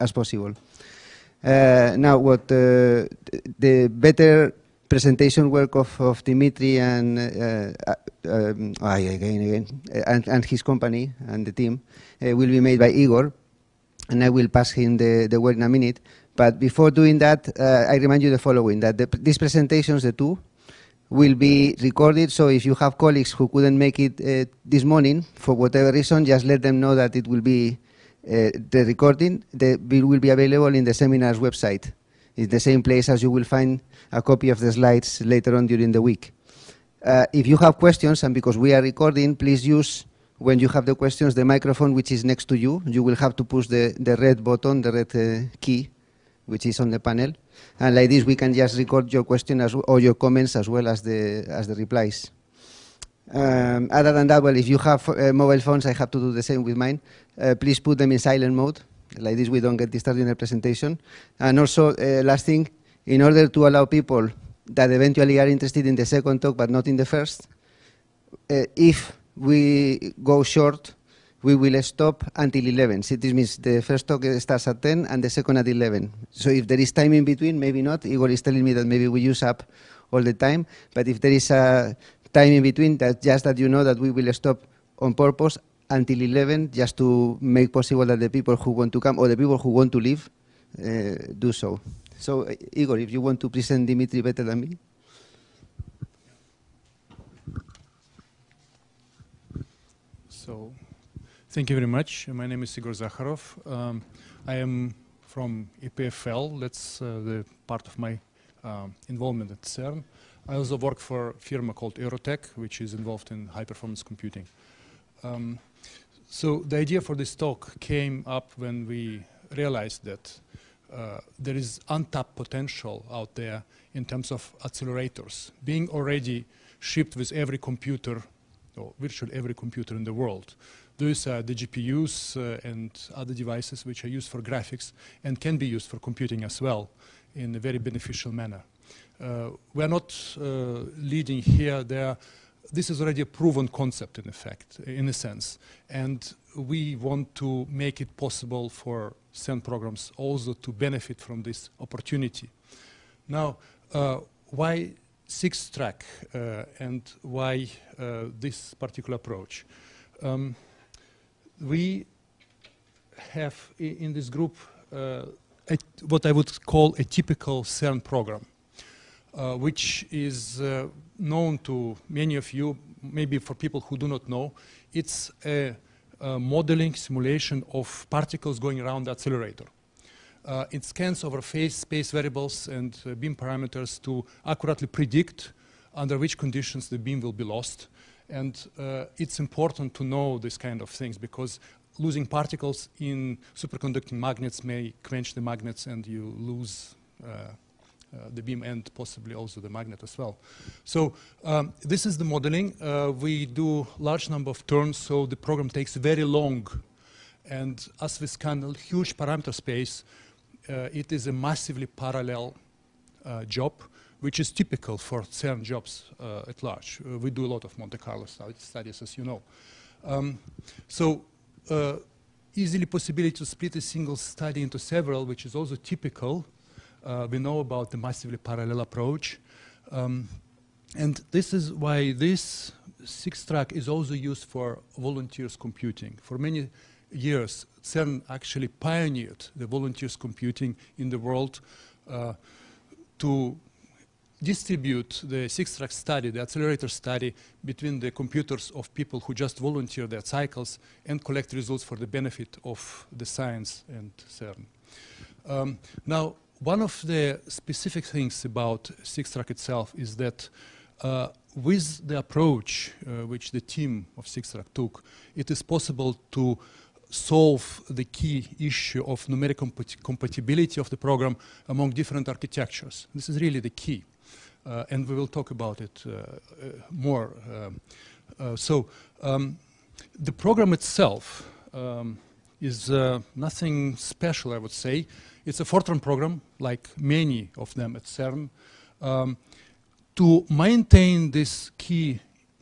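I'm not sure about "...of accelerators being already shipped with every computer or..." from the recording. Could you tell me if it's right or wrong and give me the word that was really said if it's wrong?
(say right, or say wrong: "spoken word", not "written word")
right.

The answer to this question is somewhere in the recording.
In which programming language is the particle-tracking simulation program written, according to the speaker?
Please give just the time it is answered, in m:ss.
4:45.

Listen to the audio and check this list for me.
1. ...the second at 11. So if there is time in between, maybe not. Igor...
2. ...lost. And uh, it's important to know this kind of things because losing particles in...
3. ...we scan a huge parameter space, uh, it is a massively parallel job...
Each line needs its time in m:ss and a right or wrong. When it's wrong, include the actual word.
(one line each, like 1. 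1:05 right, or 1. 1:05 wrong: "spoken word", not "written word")
1. 1:15 right
2. 3:07 right
3. 3:28 right.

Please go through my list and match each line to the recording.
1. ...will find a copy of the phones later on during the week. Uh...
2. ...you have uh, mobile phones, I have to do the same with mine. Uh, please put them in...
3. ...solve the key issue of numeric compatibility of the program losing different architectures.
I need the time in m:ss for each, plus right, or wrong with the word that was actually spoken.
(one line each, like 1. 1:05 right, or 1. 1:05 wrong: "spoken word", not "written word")
1. 0:33 wrong: "slides", not "phones"
2. 0:54 right
3. 4:27 wrong: "among", not "losing".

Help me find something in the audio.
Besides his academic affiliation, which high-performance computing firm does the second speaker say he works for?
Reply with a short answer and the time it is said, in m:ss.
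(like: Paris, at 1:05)
Eurotech, at 1:51.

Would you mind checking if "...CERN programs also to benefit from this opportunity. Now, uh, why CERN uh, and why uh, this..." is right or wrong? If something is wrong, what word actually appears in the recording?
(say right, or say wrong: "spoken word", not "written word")
wrong: "SixTrack", not "CERN".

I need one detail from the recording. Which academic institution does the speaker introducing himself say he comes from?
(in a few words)
EPFL.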